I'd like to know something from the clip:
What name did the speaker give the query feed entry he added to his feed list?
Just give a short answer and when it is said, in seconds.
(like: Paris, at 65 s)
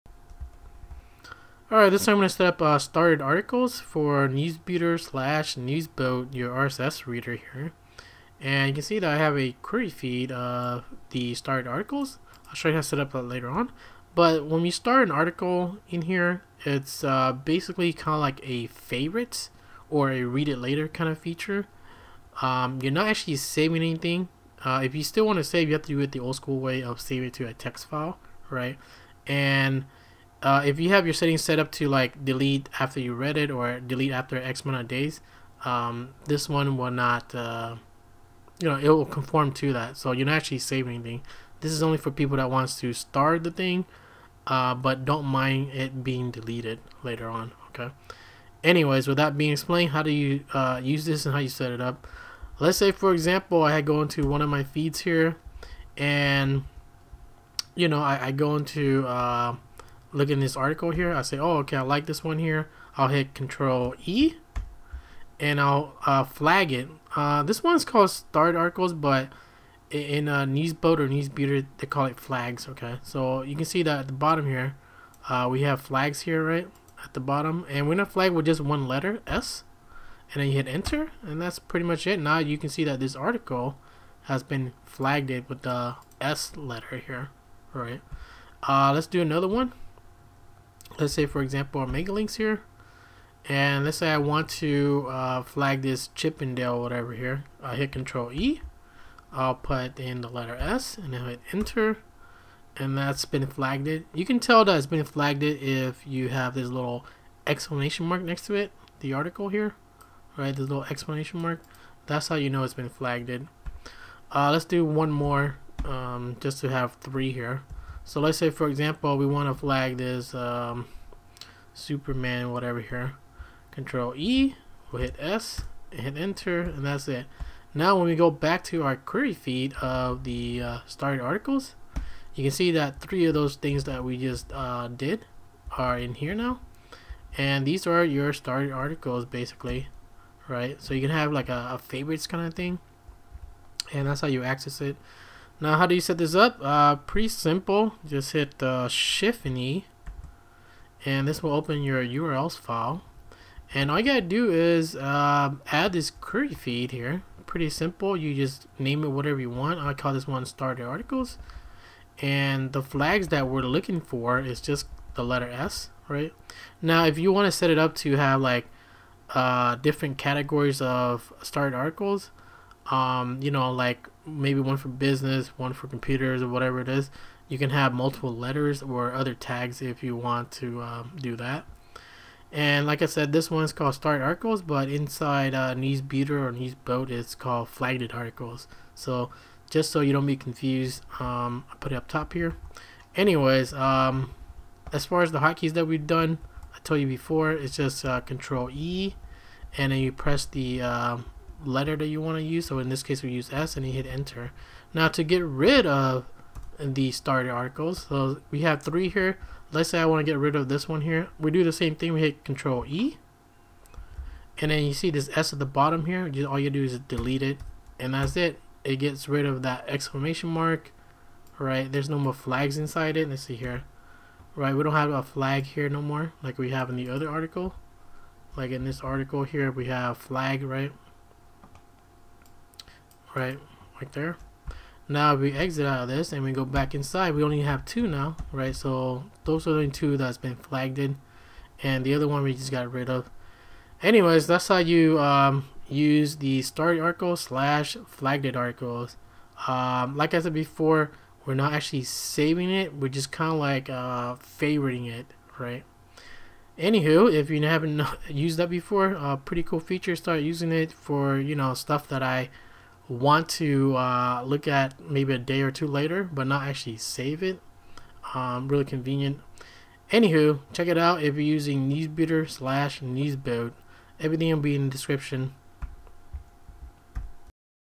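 starter articles, at 160 s.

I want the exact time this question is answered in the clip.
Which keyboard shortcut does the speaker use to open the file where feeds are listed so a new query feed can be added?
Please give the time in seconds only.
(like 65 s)
148 s.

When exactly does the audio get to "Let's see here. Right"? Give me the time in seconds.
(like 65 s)
223 s.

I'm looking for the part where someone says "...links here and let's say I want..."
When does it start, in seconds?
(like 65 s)
92 s.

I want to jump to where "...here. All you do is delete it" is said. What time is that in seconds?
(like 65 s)
216 s.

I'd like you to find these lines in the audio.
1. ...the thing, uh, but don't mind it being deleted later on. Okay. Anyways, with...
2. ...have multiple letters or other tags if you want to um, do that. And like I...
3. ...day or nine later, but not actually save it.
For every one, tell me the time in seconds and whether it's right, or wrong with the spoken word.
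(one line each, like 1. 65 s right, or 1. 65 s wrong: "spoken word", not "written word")
1. 43 s right
2. 177 s right
3. 265 s wrong: "two", not "nine".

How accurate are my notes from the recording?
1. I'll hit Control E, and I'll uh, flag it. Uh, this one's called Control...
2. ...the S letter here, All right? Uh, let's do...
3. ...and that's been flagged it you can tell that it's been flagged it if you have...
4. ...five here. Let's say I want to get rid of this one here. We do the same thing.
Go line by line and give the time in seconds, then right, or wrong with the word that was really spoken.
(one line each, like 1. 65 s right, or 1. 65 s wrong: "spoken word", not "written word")
1. 62 s wrong: "Start", not "Control"
2. 85 s right
3. 102 s right
4. 208 s wrong: "three", not "five".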